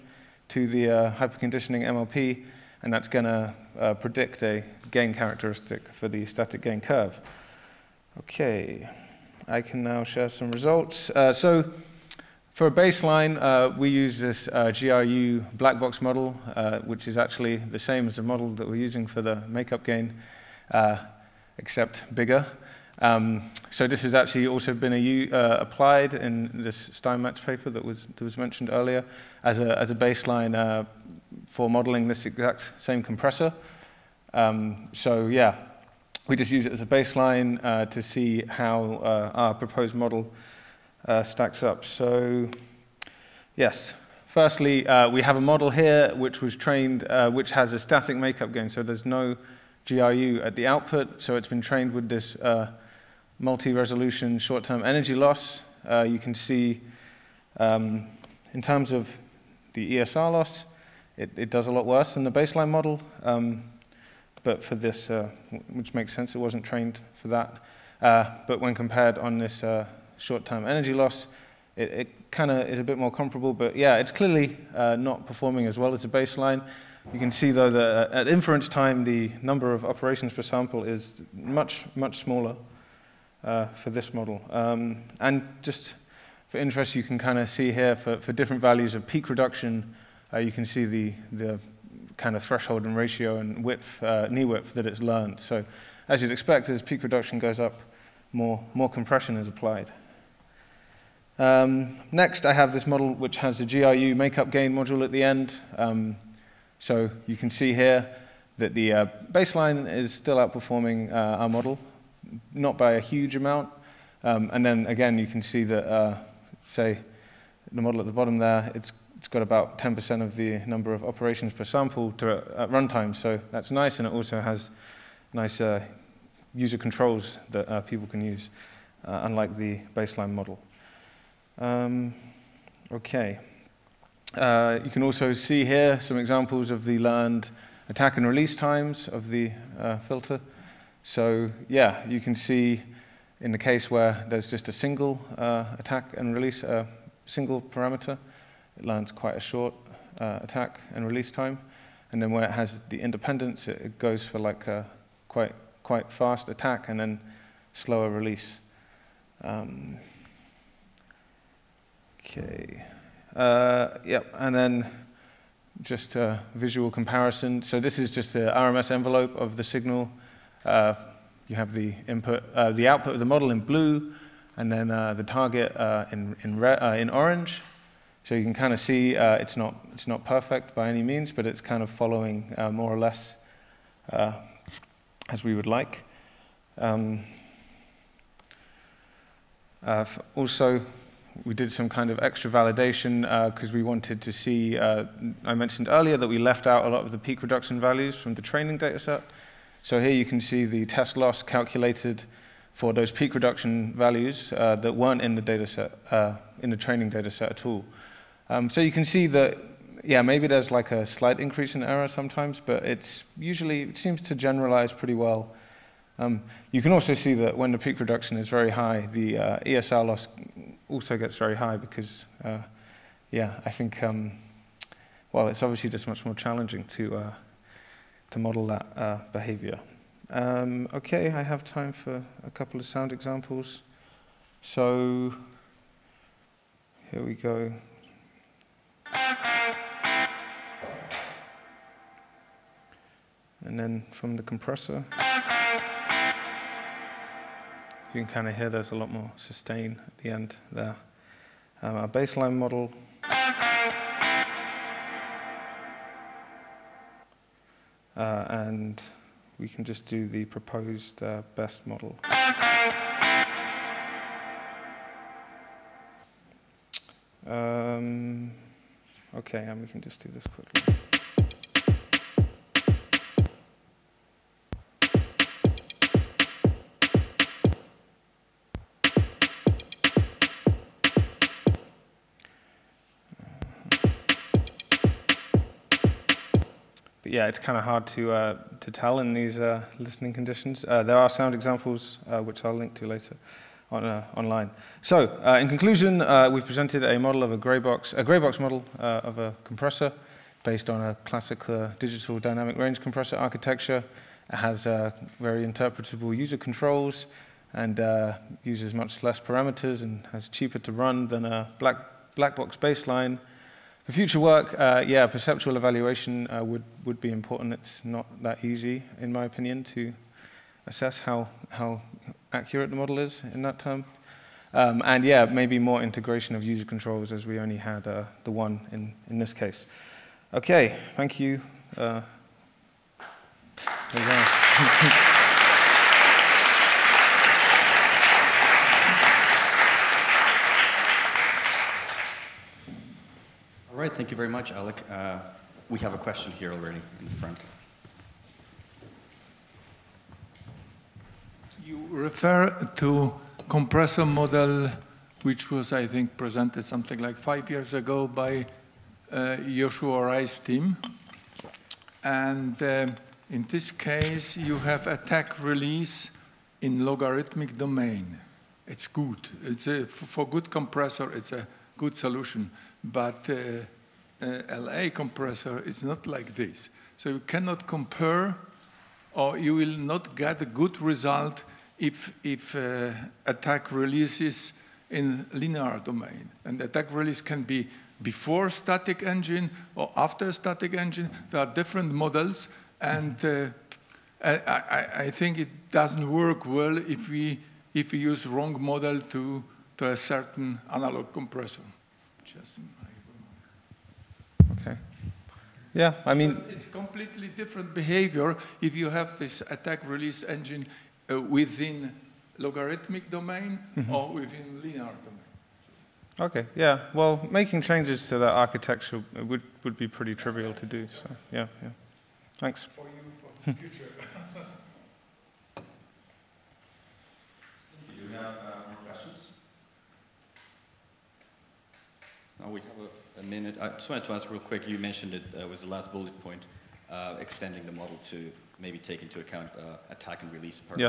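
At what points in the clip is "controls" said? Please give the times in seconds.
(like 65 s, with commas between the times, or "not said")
126 s, 306 s, 326 s.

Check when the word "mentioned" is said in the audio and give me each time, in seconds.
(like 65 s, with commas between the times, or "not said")
28 s, 195 s, 434 s.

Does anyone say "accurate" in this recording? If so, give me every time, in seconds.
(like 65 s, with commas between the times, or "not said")
322 s.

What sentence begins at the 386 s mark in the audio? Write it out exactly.
And attack release can be before static engine or after static engine.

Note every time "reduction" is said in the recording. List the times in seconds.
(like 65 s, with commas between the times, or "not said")
89 s, 97 s, 197 s, 203 s, 218 s.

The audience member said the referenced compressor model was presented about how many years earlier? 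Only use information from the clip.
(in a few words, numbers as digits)
5.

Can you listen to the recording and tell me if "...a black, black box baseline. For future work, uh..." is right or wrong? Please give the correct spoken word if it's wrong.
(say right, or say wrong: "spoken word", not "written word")
right.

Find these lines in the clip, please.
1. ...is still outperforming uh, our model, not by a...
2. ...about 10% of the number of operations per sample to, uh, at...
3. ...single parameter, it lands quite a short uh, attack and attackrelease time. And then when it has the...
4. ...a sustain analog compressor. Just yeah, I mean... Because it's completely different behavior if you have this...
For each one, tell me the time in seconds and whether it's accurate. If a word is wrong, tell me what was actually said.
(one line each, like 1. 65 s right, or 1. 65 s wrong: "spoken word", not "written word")
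1. 109 s right
2. 119 s right
3. 147 s wrong: "release", not "attackrelease"
4. 400 s wrong: "certain", not "sustain".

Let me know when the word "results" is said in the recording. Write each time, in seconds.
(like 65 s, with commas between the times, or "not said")
10 s, 381 s.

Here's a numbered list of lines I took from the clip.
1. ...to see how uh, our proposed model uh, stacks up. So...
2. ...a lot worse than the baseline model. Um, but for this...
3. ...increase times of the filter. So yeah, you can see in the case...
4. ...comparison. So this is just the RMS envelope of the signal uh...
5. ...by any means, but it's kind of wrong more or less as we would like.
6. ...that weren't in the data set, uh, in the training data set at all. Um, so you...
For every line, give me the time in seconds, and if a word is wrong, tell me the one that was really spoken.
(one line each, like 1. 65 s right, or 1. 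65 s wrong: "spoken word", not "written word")
1. 37 s right
2. 61 s right
3. 138 s wrong: "release", not "increase"
4. 166 s right
5. 180 s wrong: "following", not "wrong"
6. 204 s right.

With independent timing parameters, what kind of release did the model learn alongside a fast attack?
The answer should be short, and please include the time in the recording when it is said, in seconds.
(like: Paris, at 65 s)
Slower release, at 157 s.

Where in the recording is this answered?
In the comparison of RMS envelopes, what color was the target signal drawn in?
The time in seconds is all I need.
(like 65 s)
177 s.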